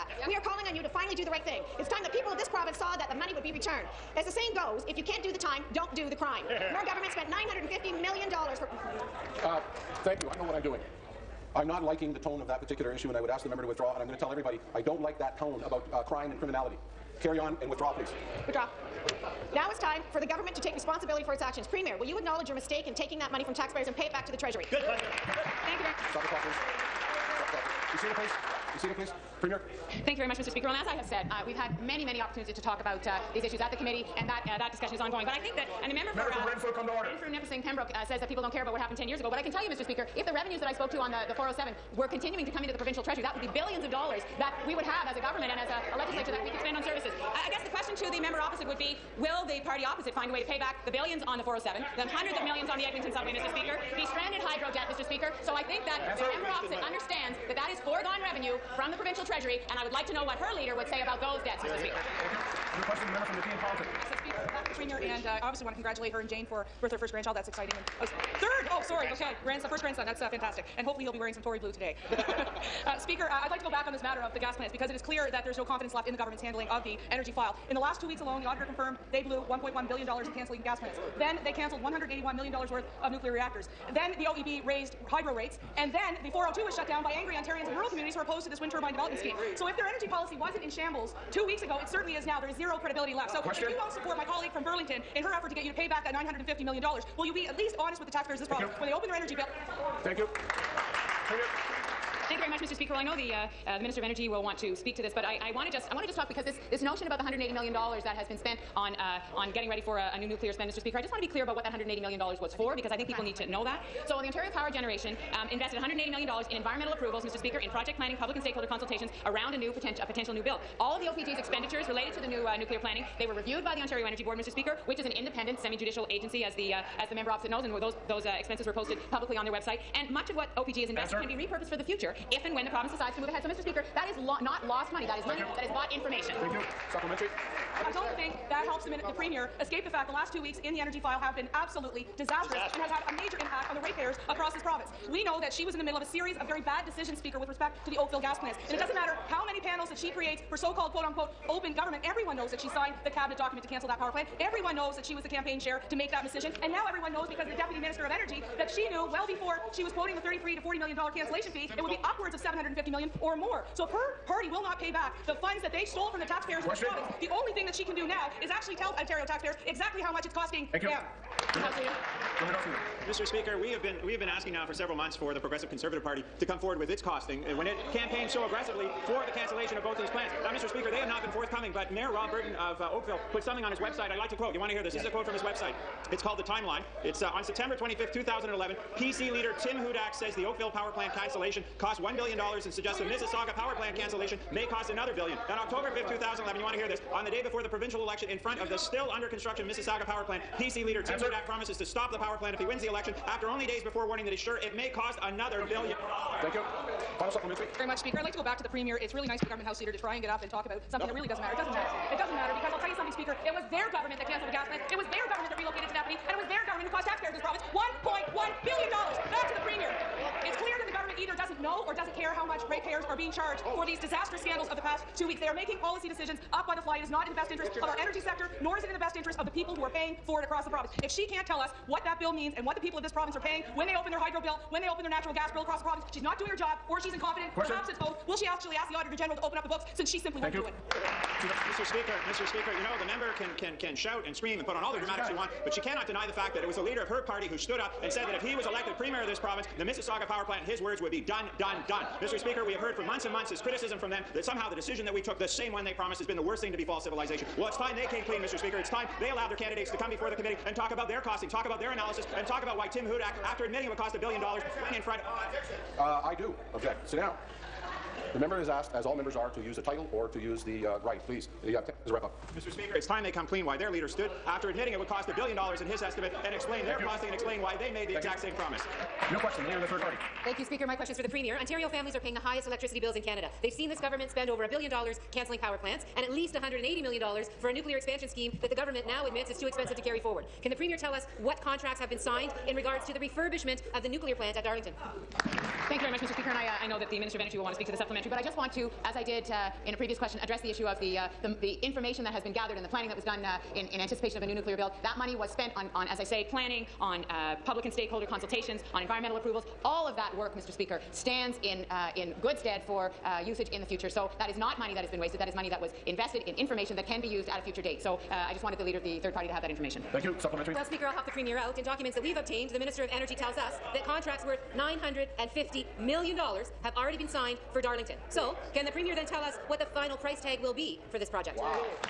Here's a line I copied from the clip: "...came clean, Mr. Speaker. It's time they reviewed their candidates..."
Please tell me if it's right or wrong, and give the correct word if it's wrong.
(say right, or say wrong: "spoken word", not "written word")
wrong: "allowed", not "reviewed".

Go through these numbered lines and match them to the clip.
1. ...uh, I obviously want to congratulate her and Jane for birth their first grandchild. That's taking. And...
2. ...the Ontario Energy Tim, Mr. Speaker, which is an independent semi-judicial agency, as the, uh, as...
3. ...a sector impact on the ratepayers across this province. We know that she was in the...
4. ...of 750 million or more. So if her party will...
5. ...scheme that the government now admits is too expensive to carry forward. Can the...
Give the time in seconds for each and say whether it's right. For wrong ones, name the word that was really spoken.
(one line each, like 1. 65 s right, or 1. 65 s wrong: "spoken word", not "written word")
1. 65 s wrong: "exciting", not "taking"
2. 123 s wrong: "Board", not "Tim"
3. 143 s wrong: "major", not "sector"
4. 162 s right
5. 288 s right.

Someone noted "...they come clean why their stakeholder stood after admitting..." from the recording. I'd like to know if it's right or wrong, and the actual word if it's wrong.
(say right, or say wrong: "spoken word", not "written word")
wrong: "leader", not "stakeholder".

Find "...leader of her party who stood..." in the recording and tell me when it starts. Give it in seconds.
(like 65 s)
246 s.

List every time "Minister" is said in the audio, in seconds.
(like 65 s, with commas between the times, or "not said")
103 s, 157 s, 297 s, 322 s.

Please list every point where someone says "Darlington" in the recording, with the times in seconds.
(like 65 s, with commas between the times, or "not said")
294 s, 327 s.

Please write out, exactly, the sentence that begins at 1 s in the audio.
It's time the people of this province saw that the money would be returned.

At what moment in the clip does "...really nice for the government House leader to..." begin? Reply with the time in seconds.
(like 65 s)
209 s.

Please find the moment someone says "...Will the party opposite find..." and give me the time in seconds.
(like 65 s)
49 s.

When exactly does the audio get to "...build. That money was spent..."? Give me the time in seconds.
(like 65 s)
304 s.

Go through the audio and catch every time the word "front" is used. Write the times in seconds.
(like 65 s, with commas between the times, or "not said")
198 s, 265 s.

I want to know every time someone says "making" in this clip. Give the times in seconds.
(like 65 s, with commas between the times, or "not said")
225 s.